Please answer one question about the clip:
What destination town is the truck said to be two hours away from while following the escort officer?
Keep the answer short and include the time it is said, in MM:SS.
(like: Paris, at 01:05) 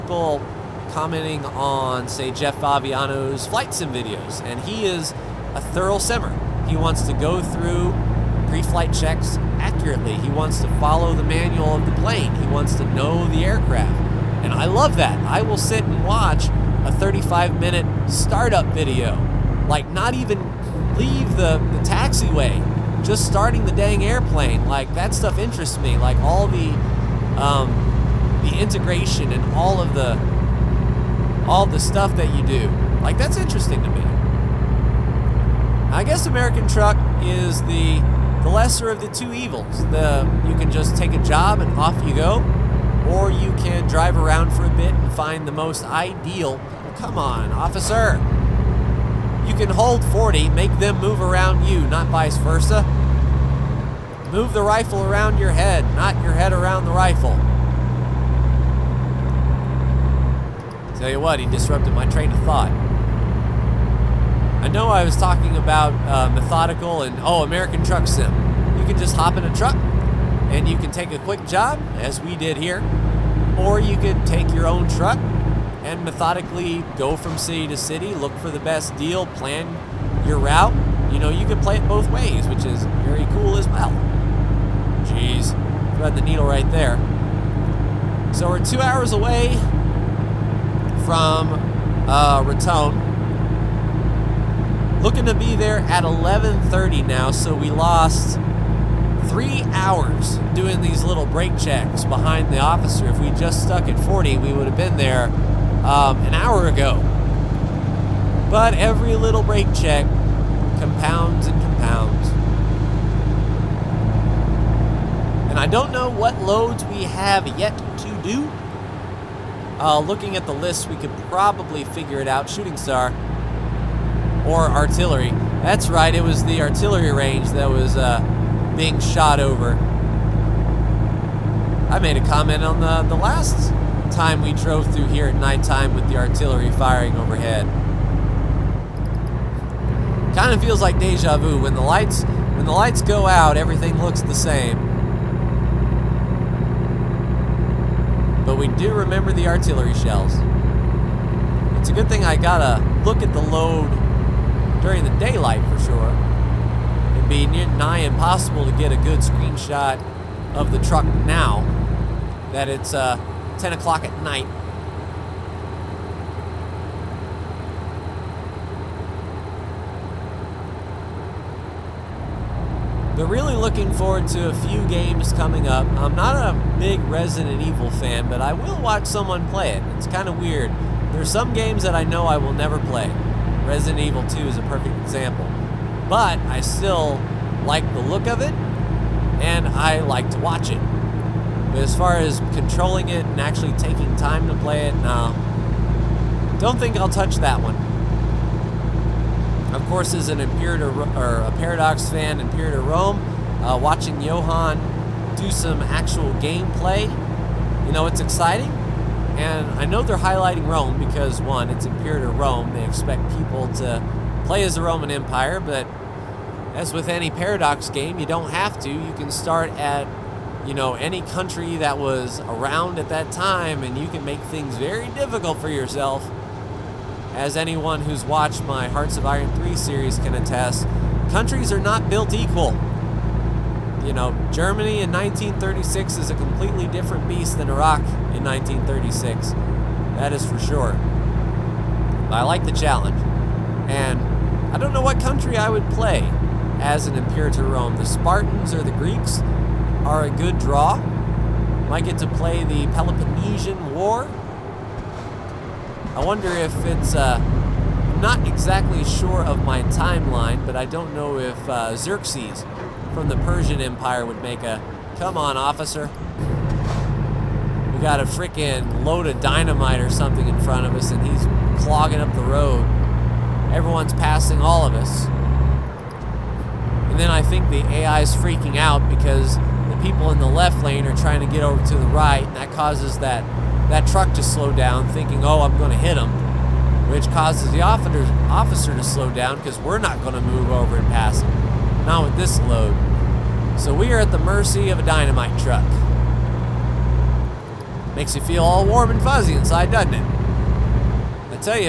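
Raton, at 01:32.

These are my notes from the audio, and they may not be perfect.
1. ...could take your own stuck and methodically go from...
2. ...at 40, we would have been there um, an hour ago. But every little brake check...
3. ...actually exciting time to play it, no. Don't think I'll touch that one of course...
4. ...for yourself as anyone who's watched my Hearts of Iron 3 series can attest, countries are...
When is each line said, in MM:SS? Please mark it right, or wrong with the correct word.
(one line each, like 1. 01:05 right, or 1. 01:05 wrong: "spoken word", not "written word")
1. 01:13 wrong: "truck", not "stuck"
2. 01:43 right
3. 03:13 wrong: "taking", not "exciting"
4. 03:45 right.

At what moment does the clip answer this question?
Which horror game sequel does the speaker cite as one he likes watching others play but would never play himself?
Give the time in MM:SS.
03:03.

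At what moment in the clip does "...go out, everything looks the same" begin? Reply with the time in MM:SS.
02:23.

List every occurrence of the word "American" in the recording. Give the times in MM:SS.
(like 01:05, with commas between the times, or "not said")
00:36, 01:07.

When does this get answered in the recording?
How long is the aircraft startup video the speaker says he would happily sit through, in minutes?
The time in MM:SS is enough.
00:16.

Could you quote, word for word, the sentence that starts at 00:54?
Move the rifle around your head, not your head around the rifle.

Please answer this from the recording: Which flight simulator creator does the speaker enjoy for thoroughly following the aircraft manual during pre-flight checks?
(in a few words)
Jeff Fabiano.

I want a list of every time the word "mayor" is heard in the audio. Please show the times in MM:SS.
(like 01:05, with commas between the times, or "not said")
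not said.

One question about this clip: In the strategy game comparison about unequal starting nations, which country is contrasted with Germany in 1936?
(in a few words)
Iraq.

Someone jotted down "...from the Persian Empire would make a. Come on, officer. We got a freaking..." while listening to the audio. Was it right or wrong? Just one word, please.
right.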